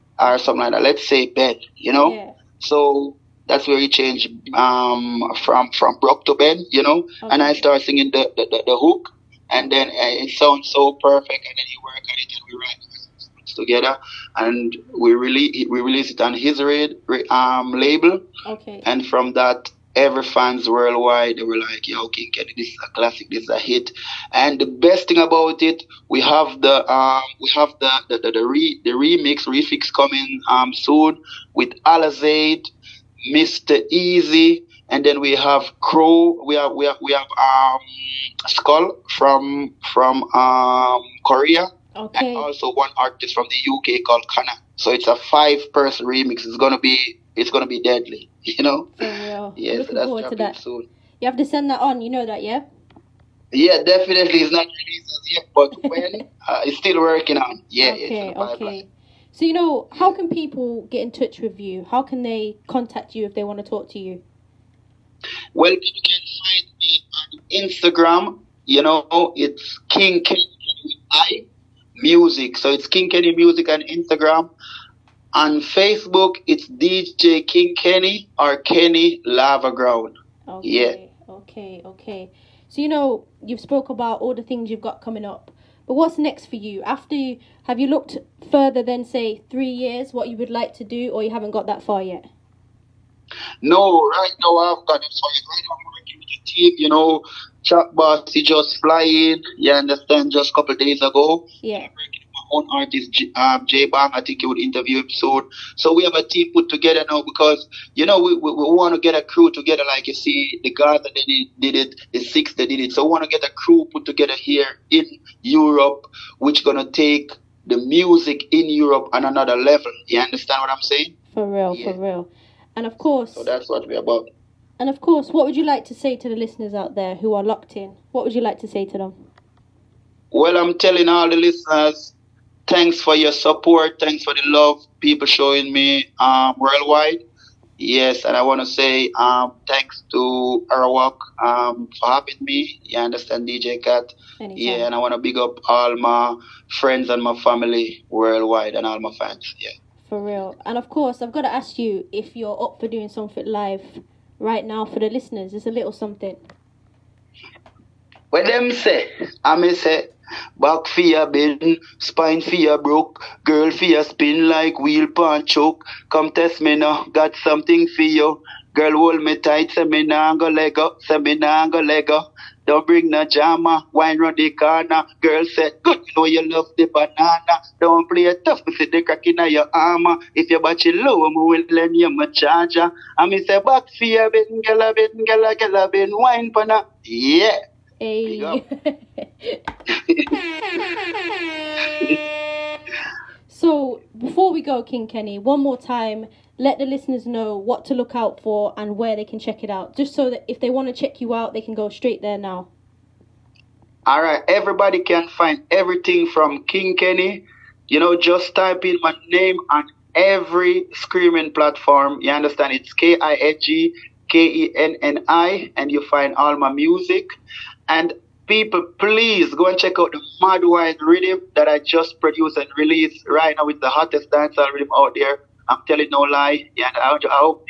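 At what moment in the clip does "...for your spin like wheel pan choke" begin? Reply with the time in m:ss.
2:43.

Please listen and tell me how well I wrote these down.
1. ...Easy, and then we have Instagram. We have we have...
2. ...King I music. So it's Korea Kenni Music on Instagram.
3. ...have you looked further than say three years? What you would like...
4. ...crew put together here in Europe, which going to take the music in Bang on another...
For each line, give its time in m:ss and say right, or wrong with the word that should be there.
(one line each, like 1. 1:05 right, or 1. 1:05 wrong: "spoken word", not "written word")
1. 0:33 wrong: "Crow", not "Instagram"
2. 1:10 wrong: "King", not "Korea"
3. 1:27 right
4. 1:53 wrong: "Europe", not "Bang".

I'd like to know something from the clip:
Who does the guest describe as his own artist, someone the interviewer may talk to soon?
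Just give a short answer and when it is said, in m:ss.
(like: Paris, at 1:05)
Jay Bang, at 1:43.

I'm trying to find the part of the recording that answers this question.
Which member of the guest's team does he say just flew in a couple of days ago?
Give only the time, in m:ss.
1:37.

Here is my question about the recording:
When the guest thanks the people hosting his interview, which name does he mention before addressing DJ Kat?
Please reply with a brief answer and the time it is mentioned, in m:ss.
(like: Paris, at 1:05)
Arawak, at 2:20.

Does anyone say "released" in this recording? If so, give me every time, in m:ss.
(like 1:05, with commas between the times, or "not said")
0:15, 0:54, 3:42.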